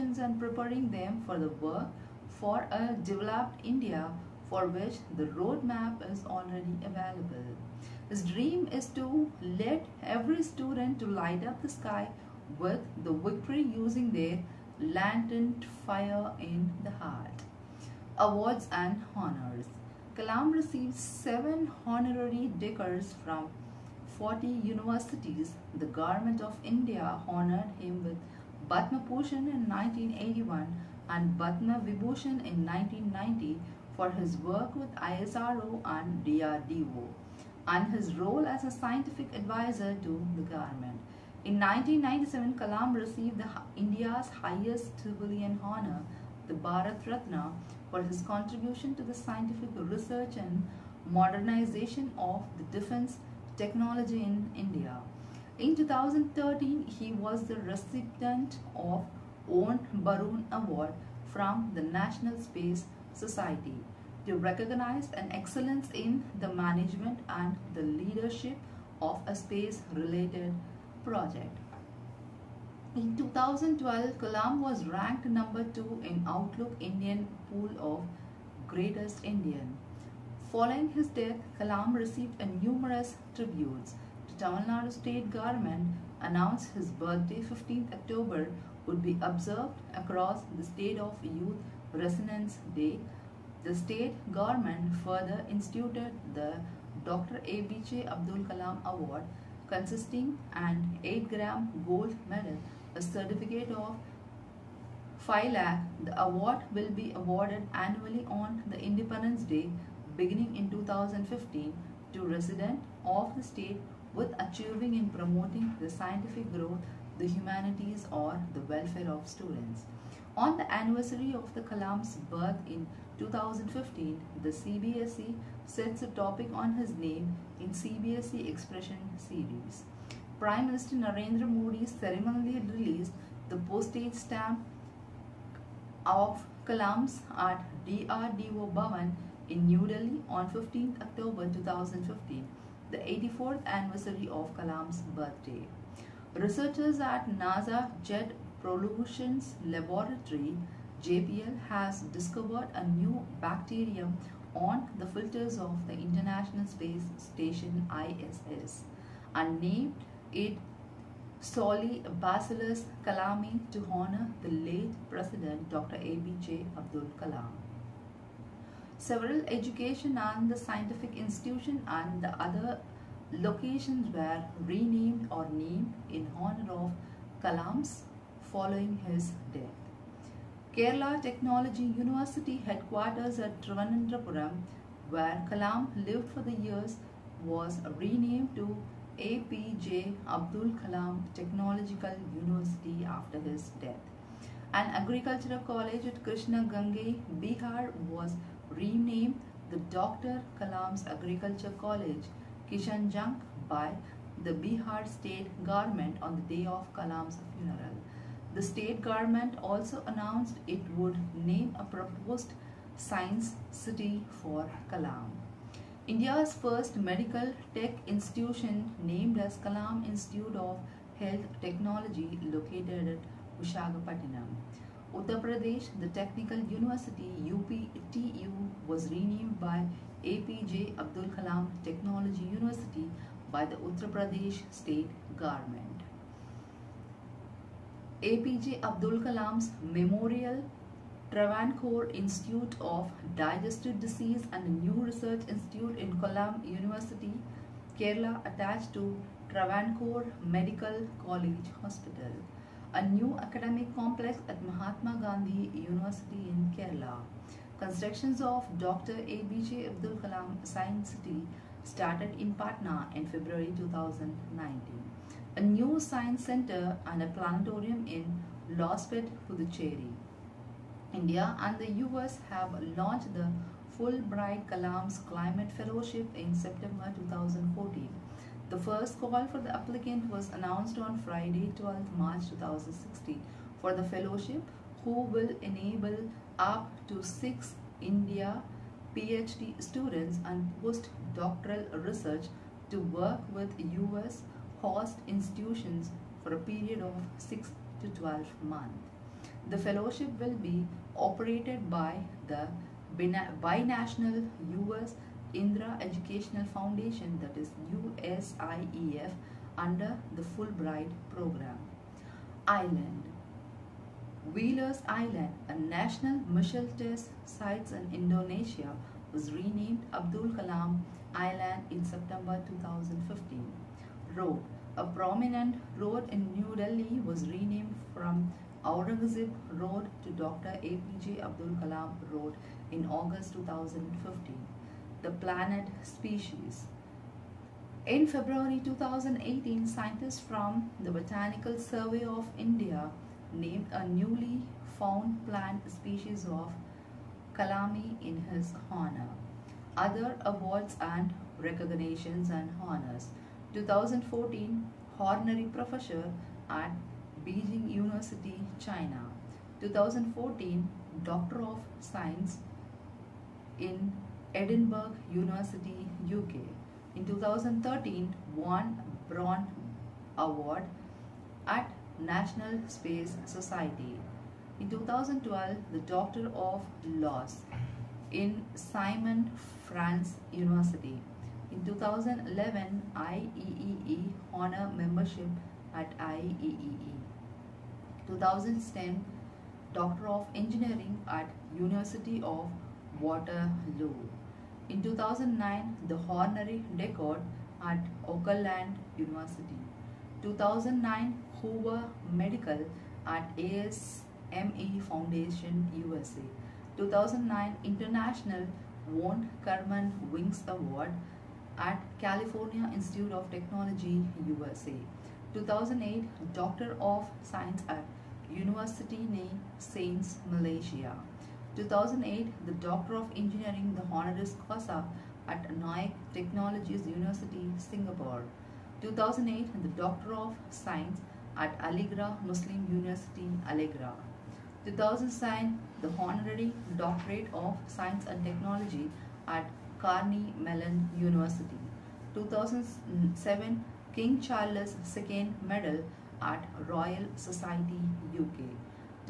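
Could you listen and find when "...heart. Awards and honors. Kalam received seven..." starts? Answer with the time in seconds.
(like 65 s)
17 s.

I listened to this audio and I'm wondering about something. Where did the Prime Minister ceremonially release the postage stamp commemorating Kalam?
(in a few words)
DRDO Bhavan.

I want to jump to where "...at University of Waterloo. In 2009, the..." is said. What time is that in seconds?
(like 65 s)
391 s.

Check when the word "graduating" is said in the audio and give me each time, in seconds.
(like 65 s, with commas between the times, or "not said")
not said.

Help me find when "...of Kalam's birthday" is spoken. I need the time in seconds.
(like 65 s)
144 s.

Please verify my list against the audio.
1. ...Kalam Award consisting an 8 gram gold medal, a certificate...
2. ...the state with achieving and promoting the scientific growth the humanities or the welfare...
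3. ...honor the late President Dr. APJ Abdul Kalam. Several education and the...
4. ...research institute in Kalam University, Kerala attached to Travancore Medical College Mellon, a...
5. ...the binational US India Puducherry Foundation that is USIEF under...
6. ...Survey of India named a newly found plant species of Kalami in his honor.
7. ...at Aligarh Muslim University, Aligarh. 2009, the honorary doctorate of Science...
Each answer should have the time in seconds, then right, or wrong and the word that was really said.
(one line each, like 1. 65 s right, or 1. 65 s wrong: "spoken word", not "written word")
1. 98 s right
2. 113 s right
3. 163 s right
4. 245 s wrong: "Hospital", not "Mellon"
5. 302 s wrong: "Educational", not "Puducherry"
6. 341 s right
7. 431 s right.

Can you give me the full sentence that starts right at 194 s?
An agricultural college at Kishanganj, Bihar was renamed the Dr.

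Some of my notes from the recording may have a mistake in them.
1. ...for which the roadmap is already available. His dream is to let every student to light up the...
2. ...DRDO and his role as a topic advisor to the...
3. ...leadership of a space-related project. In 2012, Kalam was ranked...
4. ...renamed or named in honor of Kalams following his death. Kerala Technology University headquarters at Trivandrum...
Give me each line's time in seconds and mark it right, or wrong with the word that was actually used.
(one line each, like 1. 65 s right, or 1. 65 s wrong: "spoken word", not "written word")
1. 4 s right
2. 36 s wrong: "scientific", not "topic"
3. 67 s right
4. 174 s right.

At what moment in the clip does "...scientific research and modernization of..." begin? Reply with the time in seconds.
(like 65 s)
49 s.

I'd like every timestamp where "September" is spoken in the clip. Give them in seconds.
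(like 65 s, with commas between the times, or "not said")
276 s, 322 s.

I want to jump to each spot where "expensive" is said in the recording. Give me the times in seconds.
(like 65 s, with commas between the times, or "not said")
not said.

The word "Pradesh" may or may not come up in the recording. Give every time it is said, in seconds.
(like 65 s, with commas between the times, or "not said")
225 s, 234 s.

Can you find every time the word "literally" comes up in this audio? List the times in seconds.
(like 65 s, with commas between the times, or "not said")
not said.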